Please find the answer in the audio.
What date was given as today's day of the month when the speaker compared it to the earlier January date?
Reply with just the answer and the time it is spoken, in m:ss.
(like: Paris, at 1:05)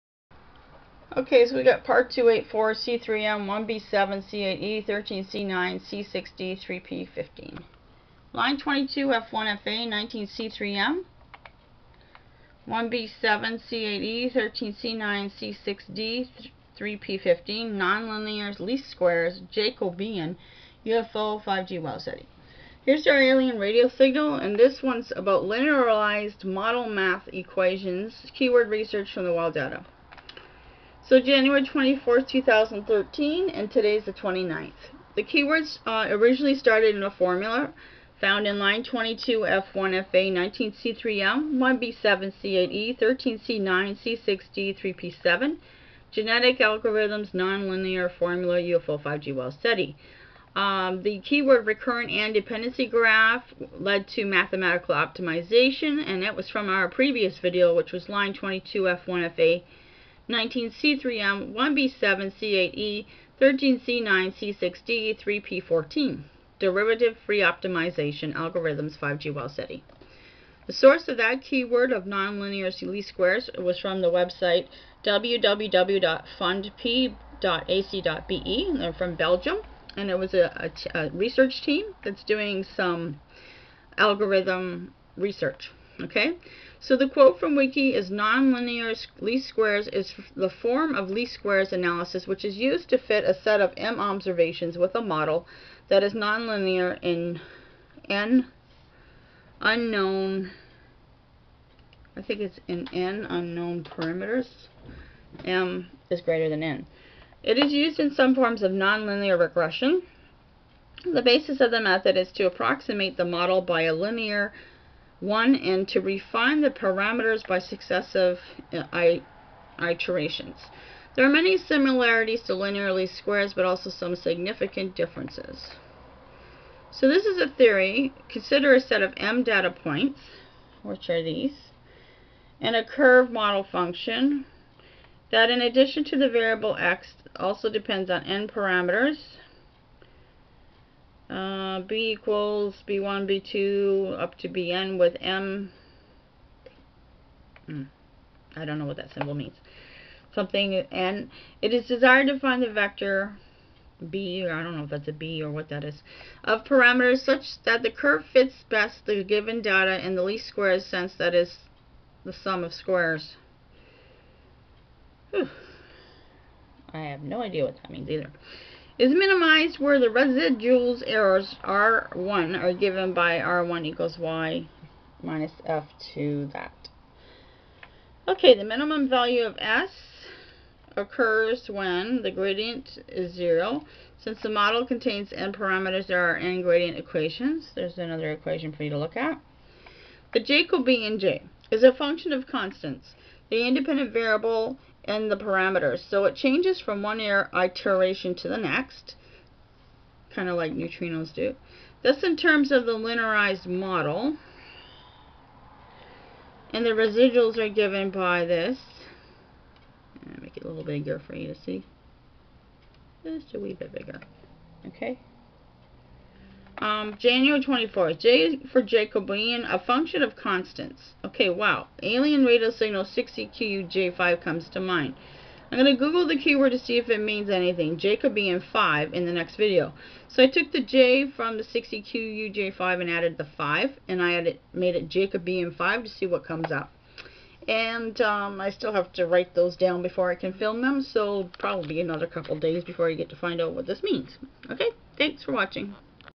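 29th, at 0:34.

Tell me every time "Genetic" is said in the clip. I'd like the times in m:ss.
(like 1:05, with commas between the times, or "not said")
0:46.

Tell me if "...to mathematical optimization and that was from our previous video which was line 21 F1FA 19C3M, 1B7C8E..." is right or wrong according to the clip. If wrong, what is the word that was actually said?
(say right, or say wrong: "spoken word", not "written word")
wrong: "22", not "21".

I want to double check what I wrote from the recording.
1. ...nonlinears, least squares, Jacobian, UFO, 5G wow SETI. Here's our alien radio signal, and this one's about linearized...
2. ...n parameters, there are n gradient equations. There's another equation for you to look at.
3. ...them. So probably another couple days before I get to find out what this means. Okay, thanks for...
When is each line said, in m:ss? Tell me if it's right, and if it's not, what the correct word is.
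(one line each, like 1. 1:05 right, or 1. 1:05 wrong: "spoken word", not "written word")
1. 0:17 right
2. 3:05 right
3. 4:00 right.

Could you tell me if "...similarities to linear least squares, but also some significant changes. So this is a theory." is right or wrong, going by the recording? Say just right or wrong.
wrong.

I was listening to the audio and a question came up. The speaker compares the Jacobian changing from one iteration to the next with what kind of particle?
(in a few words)
Neutrinos.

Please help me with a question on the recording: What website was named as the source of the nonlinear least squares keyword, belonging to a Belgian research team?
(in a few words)
www.fundp.ac.be.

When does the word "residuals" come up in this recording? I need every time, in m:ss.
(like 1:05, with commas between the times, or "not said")
2:50, 3:26.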